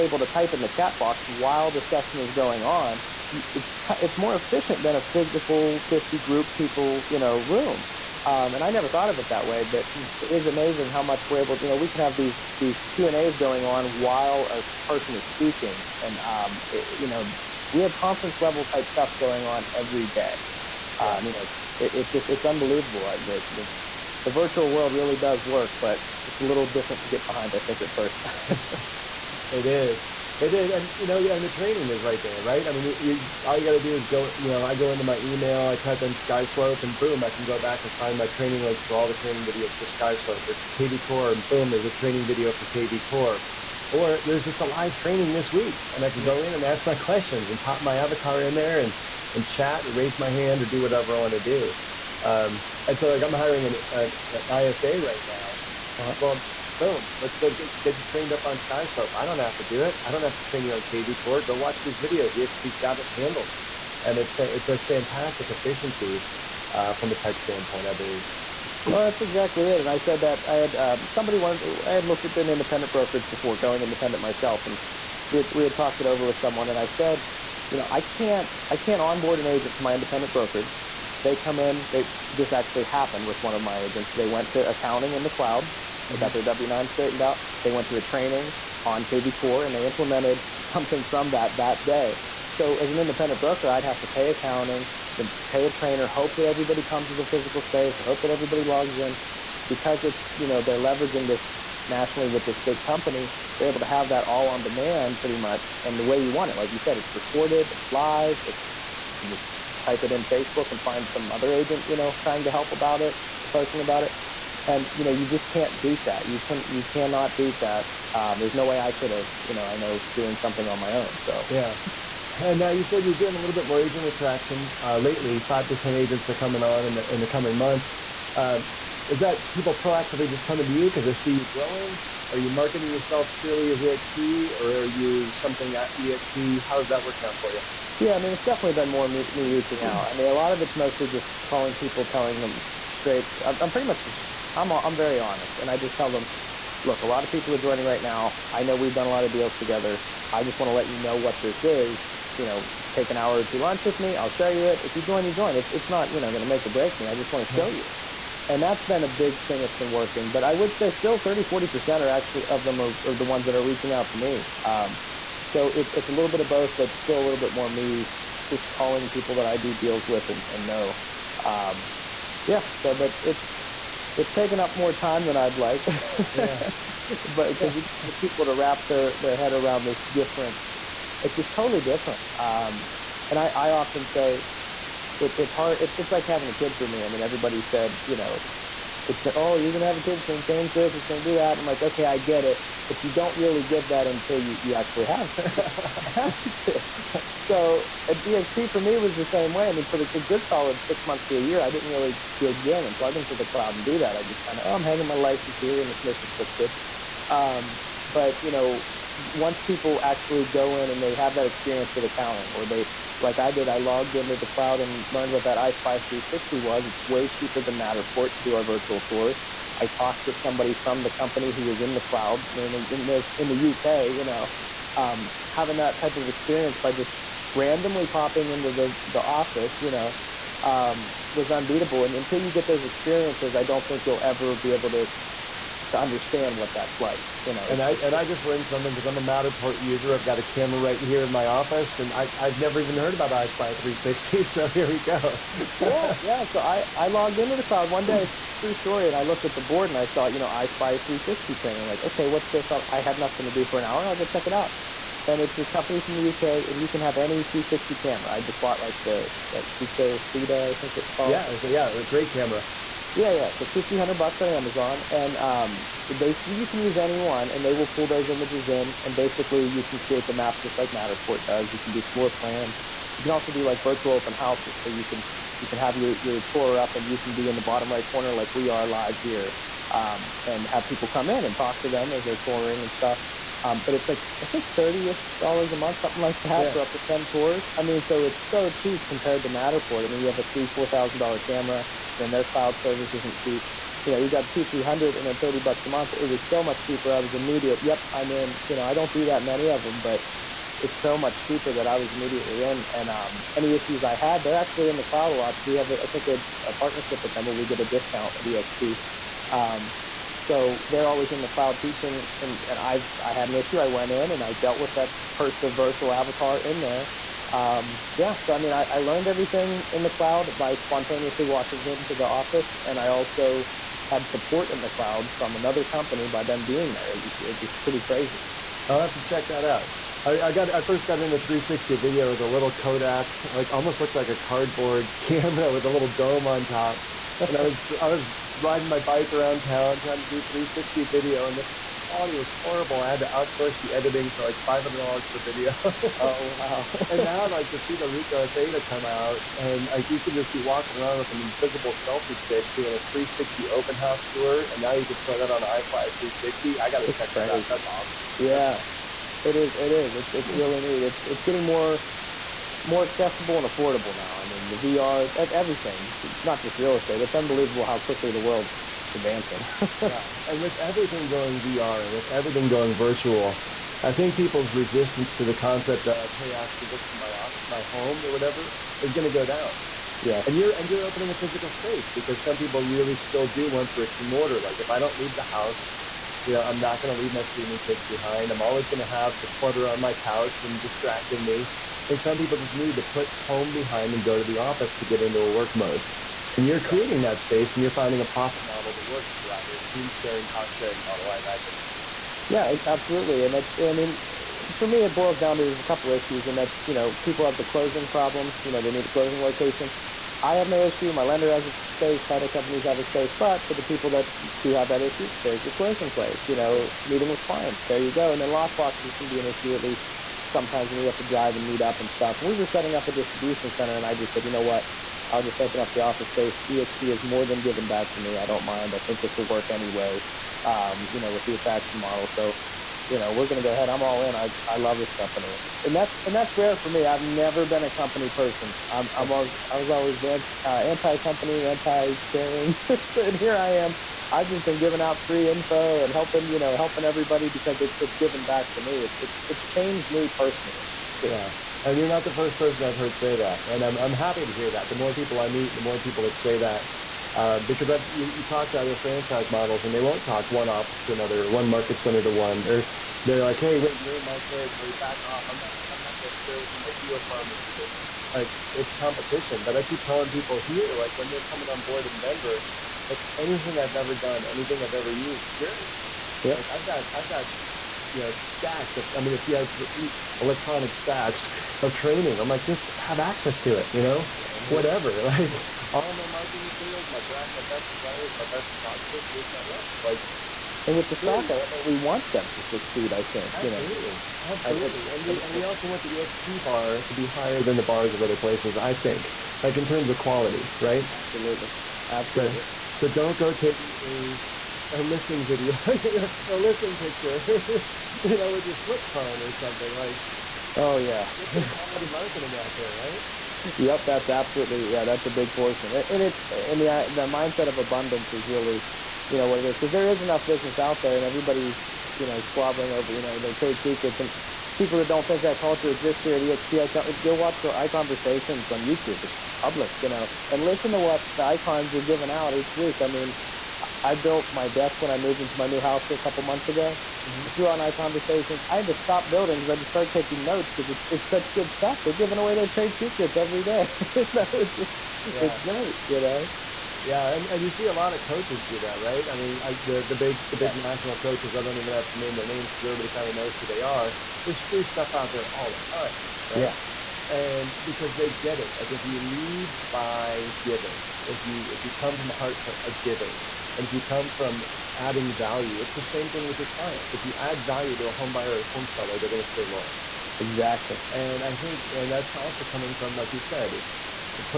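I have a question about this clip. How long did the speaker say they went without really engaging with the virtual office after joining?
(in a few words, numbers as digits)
six months to a year.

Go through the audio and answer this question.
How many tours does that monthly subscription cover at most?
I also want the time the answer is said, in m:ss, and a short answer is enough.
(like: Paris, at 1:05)
10, at 4:46.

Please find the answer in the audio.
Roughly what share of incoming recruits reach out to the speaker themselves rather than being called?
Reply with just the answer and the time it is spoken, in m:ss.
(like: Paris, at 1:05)
30-40%, at 2:41.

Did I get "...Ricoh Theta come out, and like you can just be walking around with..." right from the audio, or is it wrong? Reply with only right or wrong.
right.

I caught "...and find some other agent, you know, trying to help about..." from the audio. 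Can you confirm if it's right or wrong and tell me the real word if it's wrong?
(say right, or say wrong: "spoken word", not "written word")
right.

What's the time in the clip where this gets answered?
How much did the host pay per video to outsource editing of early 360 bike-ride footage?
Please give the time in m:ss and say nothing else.
5:44.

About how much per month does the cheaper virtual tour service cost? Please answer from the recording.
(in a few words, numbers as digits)
$30.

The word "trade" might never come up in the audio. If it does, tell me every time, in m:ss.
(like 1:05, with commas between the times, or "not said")
8:43, 9:02.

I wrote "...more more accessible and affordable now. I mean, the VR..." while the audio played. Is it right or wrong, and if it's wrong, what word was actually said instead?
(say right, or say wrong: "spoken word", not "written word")
right.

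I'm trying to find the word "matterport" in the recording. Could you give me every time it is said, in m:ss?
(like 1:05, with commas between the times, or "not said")
3:37, 3:59, 4:30, 4:49.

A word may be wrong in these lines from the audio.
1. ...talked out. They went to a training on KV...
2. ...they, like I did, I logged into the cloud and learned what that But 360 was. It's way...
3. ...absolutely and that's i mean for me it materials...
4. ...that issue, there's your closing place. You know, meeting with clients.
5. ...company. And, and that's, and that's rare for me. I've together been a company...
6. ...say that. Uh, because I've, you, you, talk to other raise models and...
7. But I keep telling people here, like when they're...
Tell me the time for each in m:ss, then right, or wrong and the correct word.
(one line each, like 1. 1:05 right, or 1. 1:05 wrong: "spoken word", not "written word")
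1. 1:26 wrong: "straightened", not "talked"
2. 3:32 wrong: "EyeSpy", not "But"
3. 6:42 wrong: "boils", not "materials"
4. 6:54 right
5. 7:15 wrong: "never", not "together"
6. 7:36 wrong: "franchise", not "raise"
7. 7:49 right.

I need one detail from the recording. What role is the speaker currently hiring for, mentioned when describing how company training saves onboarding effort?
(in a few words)
ISA.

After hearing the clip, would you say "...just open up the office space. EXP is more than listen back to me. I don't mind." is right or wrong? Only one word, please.
wrong.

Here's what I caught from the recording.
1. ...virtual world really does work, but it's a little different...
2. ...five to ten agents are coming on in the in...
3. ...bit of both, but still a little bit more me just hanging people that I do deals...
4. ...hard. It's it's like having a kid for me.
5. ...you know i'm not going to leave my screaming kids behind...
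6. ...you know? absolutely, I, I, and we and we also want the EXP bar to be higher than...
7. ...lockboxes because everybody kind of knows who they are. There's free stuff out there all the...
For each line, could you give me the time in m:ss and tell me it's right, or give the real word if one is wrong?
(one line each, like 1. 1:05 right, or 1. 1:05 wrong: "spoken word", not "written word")
1. 0:24 right
2. 2:05 right
3. 2:46 wrong: "calling", not "hanging"
4. 3:05 right
5. 6:26 right
6. 8:14 right
7. 9:12 wrong: "names", not "lockboxes".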